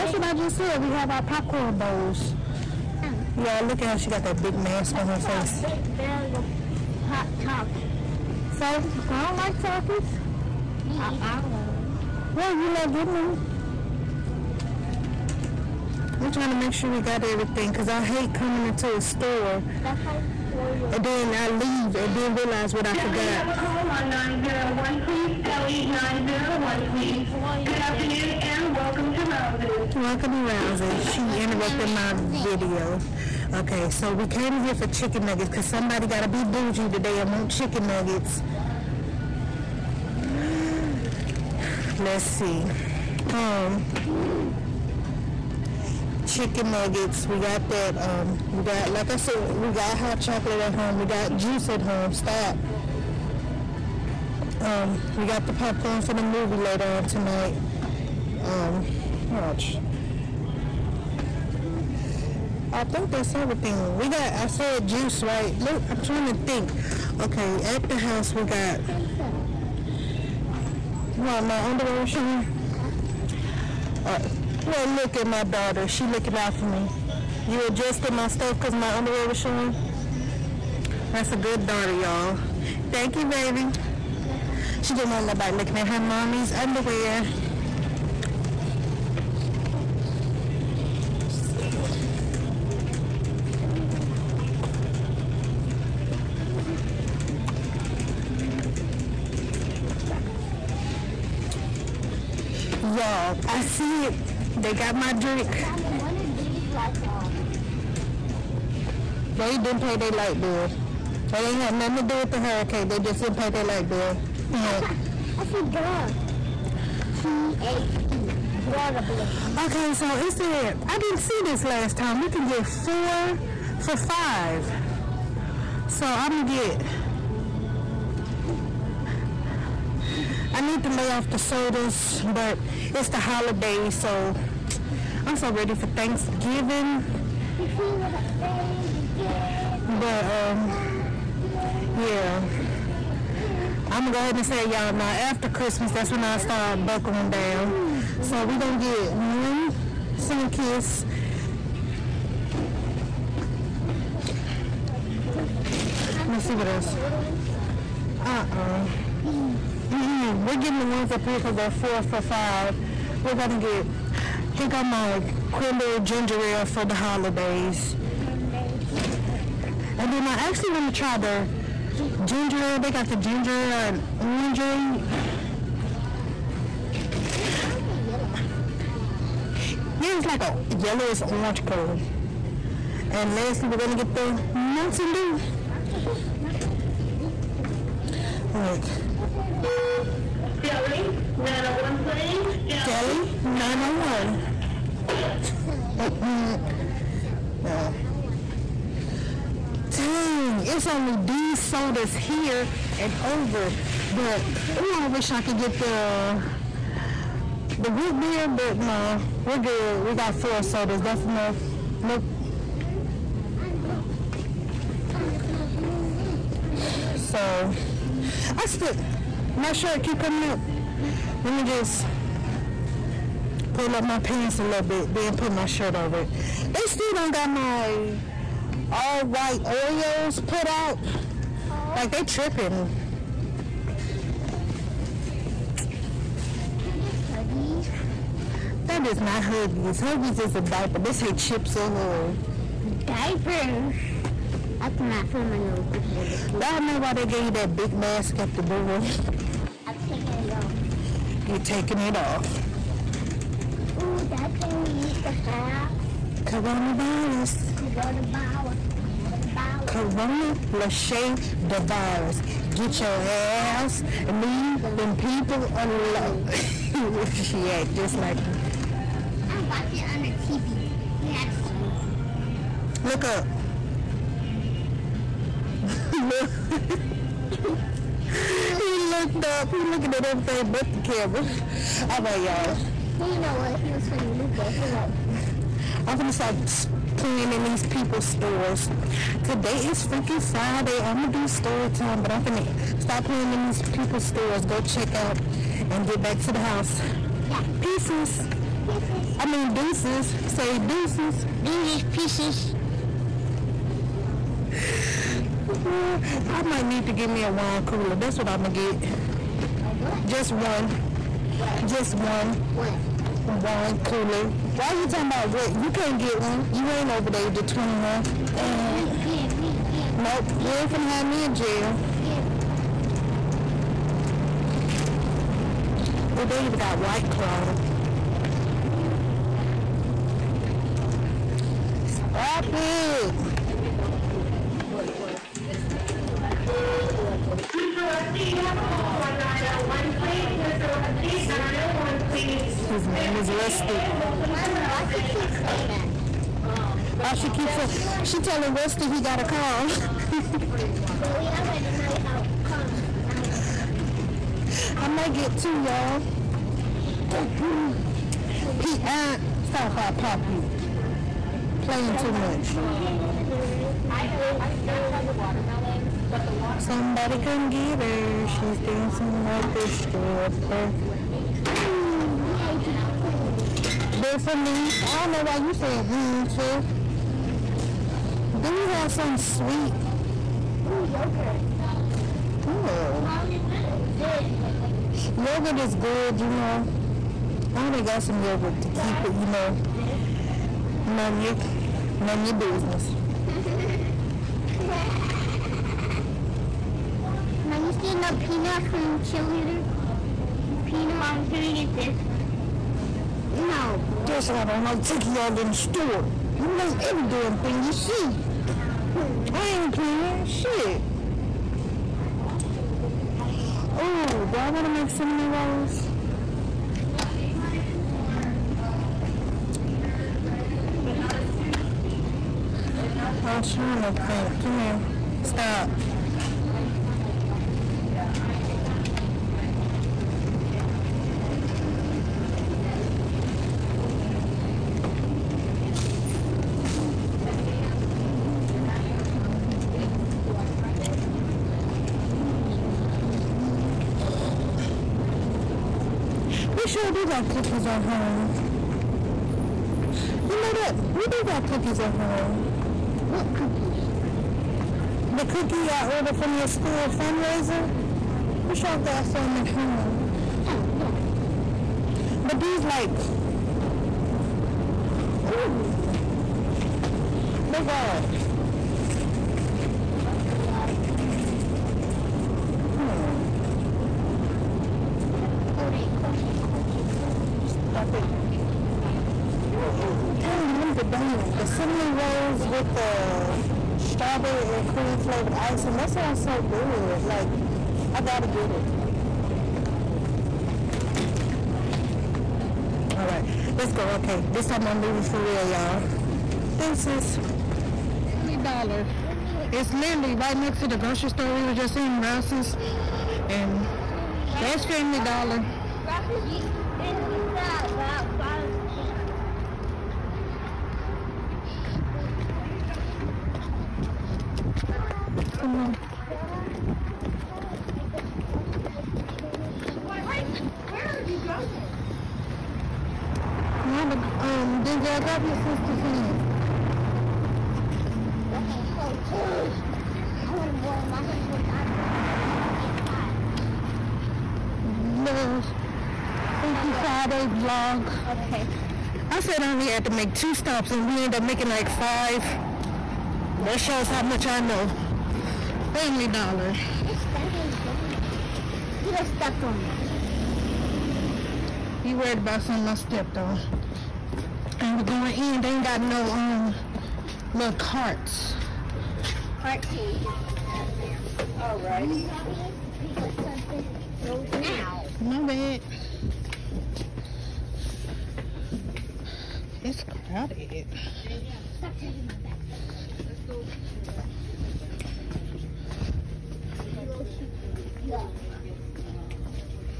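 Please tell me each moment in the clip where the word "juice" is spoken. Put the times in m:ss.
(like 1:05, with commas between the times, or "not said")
0:51, 1:04.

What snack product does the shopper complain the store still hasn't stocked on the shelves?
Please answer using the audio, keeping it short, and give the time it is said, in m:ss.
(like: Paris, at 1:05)
all white Oreos, at 3:48.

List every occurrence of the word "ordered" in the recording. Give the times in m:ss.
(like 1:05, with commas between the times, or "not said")
7:36.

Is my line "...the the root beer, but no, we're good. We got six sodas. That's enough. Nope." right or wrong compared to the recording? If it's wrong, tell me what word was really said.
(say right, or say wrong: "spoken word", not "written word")
wrong: "four", not "six".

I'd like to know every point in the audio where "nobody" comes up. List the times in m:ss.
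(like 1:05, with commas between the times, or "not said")
1:25.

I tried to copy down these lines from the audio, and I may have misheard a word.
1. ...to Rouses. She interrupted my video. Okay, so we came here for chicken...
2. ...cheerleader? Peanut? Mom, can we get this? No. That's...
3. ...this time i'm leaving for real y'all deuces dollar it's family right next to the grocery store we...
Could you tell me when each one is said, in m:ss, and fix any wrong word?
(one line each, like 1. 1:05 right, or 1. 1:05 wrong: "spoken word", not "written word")
1. 0:30 right
2. 6:39 right
3. 8:14 wrong: "literally", not "family".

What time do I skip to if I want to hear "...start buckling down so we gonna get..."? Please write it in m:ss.
2:26.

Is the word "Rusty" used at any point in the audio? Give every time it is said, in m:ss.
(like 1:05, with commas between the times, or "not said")
5:43, 5:48.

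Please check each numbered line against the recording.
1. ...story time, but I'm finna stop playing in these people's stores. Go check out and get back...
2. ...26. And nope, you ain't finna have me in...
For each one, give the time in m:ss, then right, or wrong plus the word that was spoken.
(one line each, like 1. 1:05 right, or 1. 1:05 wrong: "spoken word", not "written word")
1. 4:51 right
2. 5:17 wrong: "21", not "26".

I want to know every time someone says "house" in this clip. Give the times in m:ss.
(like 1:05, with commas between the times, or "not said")
1:07, 4:56.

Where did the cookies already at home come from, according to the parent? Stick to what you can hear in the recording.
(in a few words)
school fundraiser.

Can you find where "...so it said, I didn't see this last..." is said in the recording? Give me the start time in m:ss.
1:59.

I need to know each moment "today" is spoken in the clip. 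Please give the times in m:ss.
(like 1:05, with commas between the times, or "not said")
0:36, 4:49.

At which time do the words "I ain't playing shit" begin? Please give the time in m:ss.
6:49.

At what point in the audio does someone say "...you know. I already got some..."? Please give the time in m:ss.
6:26.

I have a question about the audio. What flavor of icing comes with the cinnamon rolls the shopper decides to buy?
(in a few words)
strawberry and cream.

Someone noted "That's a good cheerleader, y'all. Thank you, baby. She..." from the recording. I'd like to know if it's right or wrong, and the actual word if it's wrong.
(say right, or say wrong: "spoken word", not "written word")
wrong: "daughter", not "cheerleader".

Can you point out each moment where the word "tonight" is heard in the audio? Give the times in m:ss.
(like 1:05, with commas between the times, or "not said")
0:57.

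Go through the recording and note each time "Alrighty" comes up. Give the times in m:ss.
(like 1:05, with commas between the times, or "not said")
9:21.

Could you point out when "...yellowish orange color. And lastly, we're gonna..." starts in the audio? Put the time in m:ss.
3:00.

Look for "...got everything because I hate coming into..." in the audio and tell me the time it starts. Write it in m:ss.
0:17.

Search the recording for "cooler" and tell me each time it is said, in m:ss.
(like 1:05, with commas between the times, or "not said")
5:07, 5:14.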